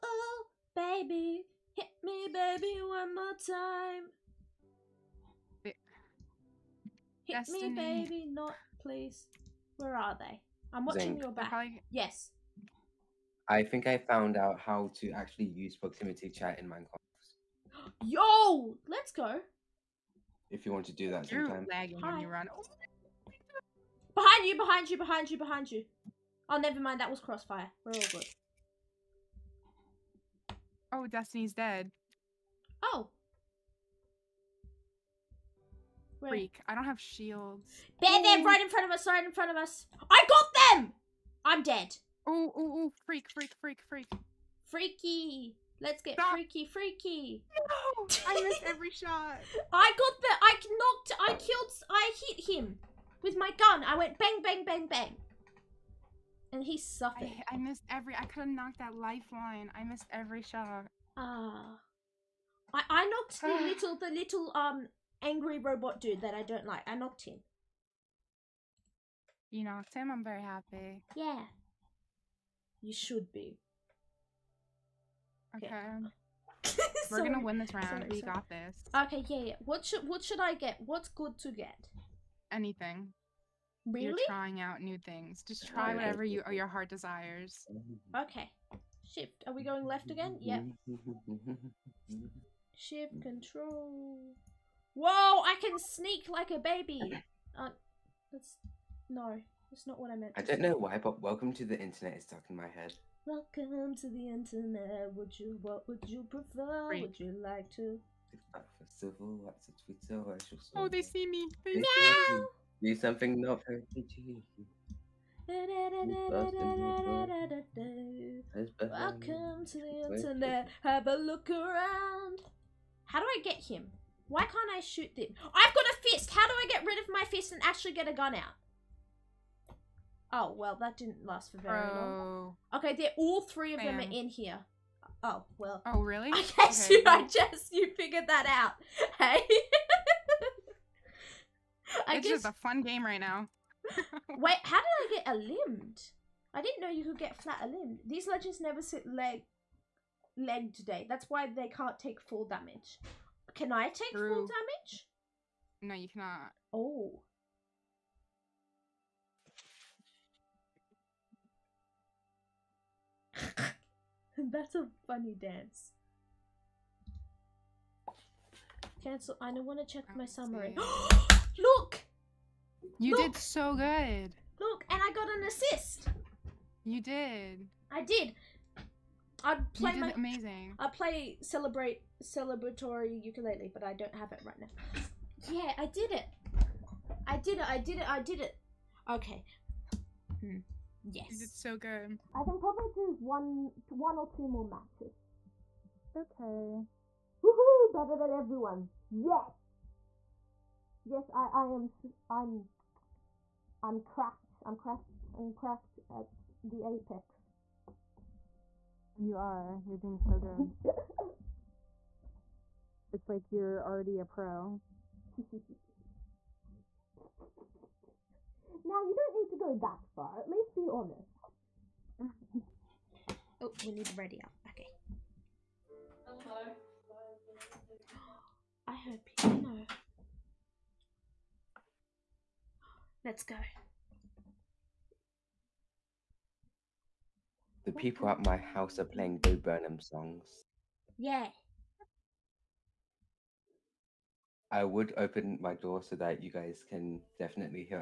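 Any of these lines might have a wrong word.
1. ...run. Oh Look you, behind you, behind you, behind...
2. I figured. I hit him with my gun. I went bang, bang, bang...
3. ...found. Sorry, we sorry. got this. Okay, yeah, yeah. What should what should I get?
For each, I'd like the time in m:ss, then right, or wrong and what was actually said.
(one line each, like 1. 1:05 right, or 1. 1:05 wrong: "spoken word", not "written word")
1. 0:22 wrong: "Behind", not "Look"
2. 0:51 wrong: "killed", not "figured"
3. 1:17 wrong: "round", not "found".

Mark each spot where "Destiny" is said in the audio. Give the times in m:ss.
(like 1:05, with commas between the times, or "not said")
0:07, 0:31.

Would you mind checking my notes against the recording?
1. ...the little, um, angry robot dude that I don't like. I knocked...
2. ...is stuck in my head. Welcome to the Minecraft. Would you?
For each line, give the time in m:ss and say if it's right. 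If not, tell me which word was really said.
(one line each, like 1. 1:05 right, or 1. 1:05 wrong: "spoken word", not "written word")
1. 1:03 right
2. 1:42 wrong: "Internet", not "Minecraft".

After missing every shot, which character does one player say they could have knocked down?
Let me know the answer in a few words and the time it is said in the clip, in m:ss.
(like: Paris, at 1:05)
Lifeline, at 0:58.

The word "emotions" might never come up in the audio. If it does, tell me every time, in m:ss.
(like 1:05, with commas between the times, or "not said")
not said.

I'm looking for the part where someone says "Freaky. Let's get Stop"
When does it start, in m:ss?
0:44.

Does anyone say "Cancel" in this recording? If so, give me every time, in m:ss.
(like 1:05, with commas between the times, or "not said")
2:49.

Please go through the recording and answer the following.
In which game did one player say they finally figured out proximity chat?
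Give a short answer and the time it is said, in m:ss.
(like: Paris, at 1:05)
Minecraft, at 0:16.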